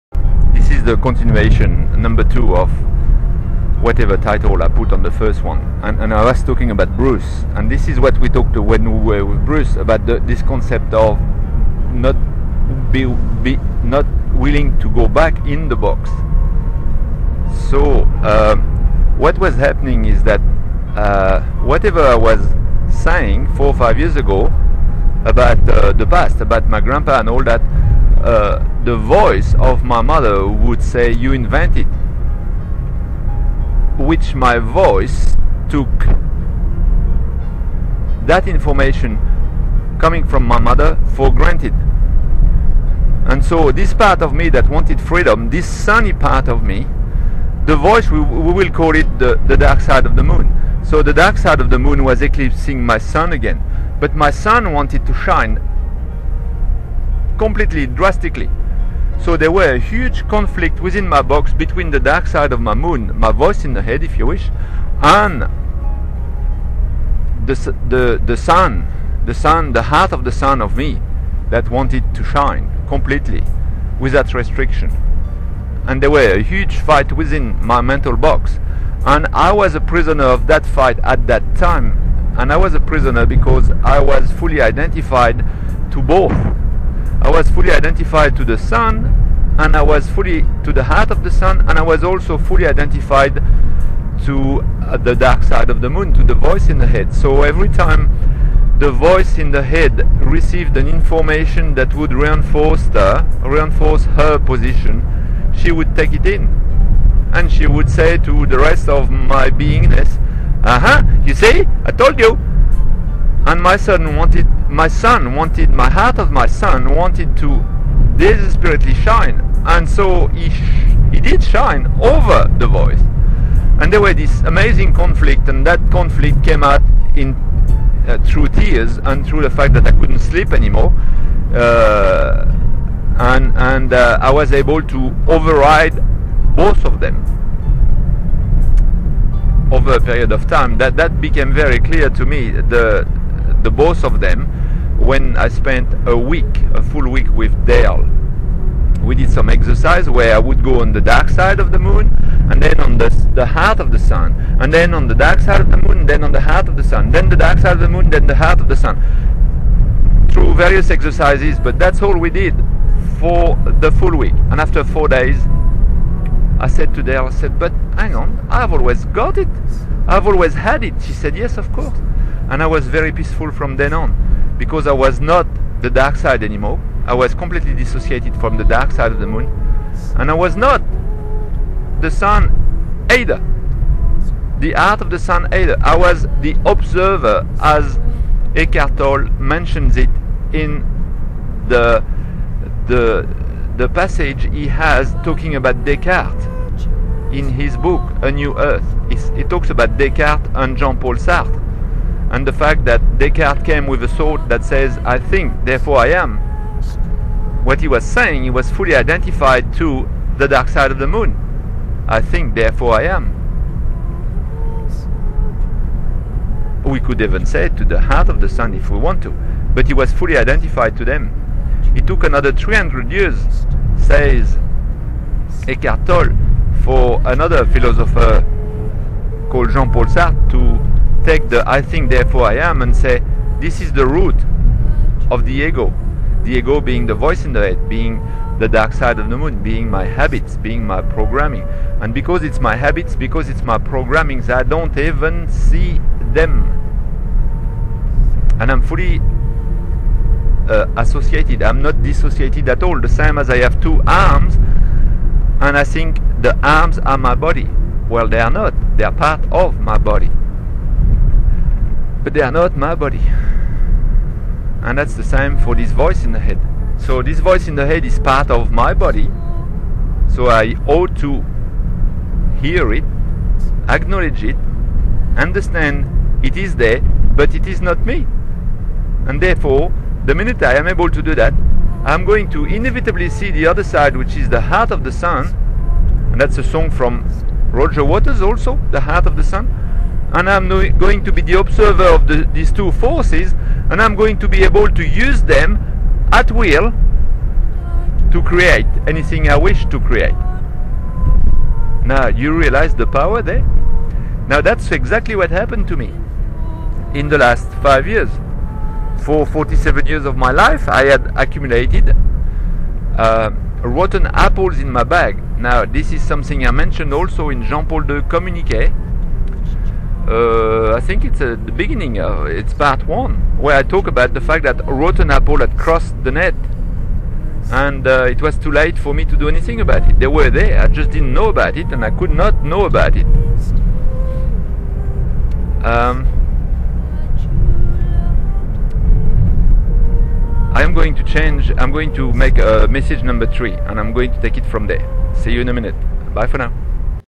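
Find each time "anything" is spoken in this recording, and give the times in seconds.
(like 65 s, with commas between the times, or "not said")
299 s, 329 s.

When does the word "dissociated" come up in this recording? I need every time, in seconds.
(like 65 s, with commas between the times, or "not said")
177 s, 252 s.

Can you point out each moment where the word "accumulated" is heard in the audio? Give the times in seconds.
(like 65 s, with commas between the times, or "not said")
311 s.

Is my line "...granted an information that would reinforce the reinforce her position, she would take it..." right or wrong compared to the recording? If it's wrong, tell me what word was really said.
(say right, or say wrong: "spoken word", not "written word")
wrong: "received", not "granted".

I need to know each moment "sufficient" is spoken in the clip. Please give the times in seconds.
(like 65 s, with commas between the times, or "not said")
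not said.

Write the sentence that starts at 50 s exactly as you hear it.
So, the dark side of the moon was eclipsing my sun again.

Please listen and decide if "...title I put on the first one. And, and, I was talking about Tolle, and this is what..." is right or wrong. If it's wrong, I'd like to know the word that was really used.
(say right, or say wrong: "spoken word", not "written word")
wrong: "Bruce", not "Tolle".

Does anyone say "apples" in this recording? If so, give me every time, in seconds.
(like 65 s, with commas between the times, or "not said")
314 s, 325 s.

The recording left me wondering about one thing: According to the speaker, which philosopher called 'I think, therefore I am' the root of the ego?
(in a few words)
Jean-Paul Sartre.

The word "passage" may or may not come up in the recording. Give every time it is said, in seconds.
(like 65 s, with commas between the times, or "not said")
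193 s.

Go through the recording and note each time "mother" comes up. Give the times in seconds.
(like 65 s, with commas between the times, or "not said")
30 s, 40 s.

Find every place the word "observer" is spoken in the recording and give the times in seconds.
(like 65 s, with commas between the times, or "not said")
186 s, 291 s.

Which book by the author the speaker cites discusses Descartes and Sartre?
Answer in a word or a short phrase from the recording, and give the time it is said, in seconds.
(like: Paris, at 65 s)
A New Earth, at 198 s.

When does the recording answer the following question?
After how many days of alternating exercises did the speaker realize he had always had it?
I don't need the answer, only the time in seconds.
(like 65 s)
164 s.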